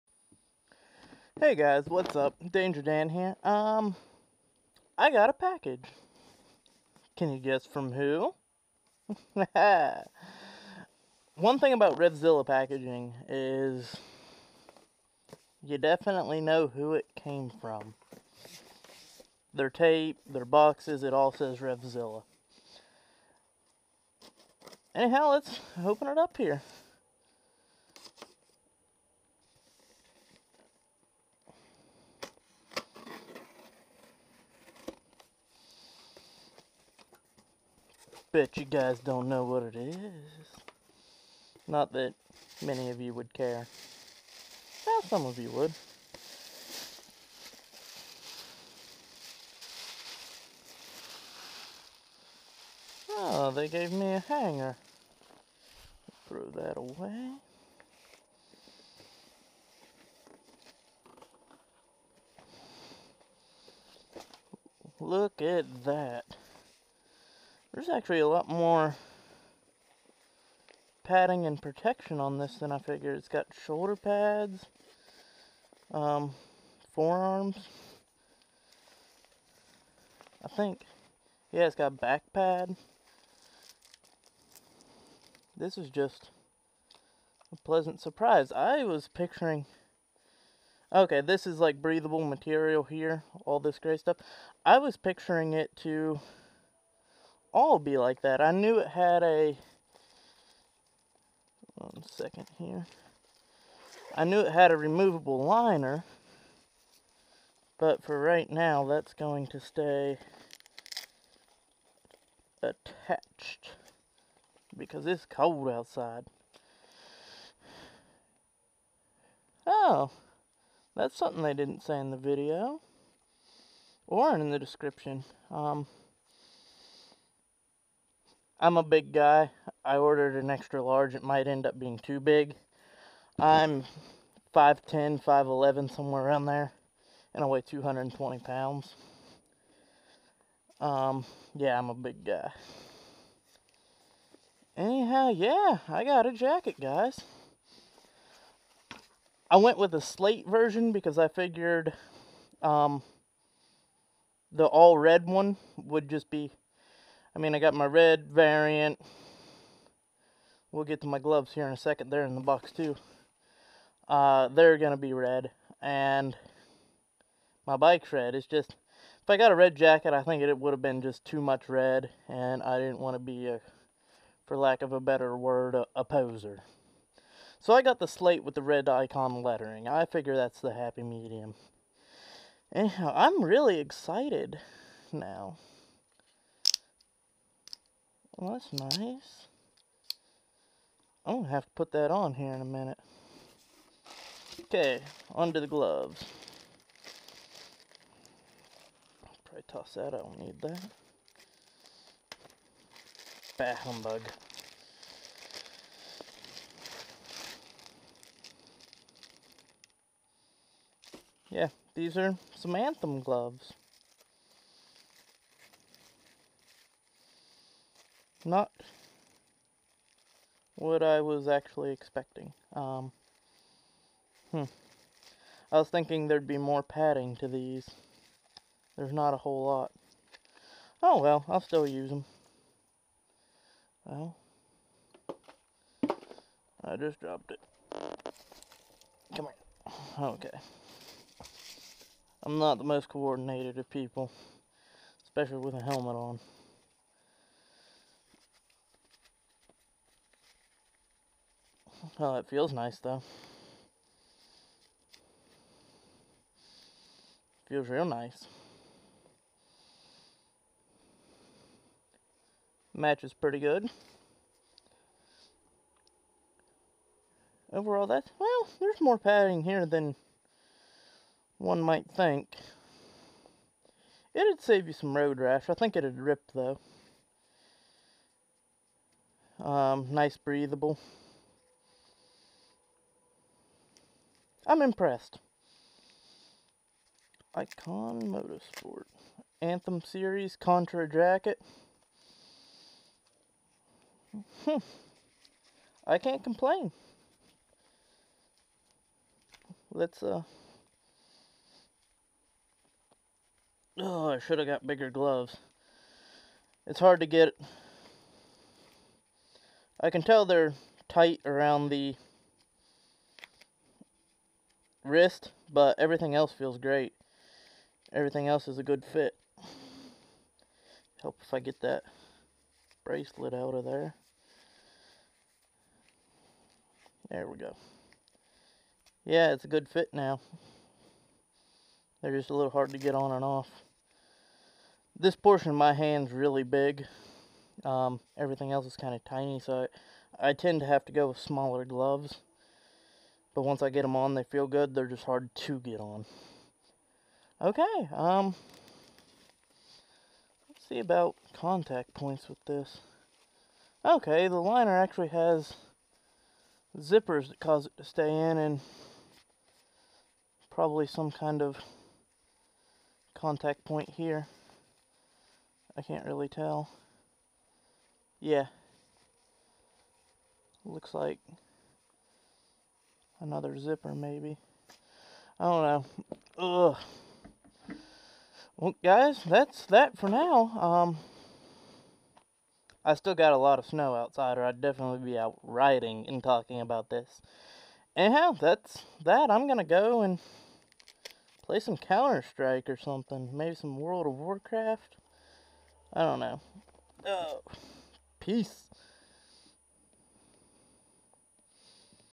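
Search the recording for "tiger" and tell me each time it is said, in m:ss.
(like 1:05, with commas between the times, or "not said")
not said.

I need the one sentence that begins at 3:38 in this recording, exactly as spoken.
not what I was actually expecting.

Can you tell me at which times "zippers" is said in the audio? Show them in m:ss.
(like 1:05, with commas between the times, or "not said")
5:56, 6:13.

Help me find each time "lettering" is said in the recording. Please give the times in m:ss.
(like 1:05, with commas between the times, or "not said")
2:59.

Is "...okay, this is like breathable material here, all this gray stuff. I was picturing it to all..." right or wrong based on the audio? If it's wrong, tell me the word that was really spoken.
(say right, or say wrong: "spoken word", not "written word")
right.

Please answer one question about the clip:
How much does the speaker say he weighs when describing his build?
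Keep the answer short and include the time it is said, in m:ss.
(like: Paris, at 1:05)
220 pounds, at 2:17.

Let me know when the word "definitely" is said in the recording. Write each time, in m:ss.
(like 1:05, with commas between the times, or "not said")
0:15, 6:24.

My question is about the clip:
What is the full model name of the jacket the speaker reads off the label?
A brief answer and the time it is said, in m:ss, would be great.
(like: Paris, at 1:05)
Anthem Series Contra Jacket, at 4:49.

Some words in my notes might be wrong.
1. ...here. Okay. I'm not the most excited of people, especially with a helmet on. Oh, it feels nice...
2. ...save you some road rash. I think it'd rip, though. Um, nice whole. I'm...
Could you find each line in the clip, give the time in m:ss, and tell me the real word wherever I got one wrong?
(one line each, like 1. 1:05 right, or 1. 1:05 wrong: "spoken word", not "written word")
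1. 3:59 wrong: "coordinated", not "excited"
2. 4:34 wrong: "breathable", not "whole".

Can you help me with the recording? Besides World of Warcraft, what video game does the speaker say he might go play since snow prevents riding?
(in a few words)
Counter Strike.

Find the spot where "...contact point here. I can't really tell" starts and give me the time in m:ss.
6:03.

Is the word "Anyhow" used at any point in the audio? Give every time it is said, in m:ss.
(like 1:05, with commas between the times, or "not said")
0:24, 2:24, 3:02, 6:28.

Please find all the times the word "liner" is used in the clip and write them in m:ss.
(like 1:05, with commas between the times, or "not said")
1:45, 5:54.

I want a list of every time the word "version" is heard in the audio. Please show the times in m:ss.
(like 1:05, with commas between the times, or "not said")
2:30.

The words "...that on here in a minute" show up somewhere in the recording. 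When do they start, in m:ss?
3:11.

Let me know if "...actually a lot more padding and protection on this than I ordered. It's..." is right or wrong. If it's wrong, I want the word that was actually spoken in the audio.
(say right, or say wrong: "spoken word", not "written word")
wrong: "figured", not "ordered".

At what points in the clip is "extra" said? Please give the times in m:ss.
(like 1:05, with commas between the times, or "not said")
2:10.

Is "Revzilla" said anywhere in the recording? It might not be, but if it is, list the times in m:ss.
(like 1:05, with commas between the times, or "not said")
0:11, 0:21.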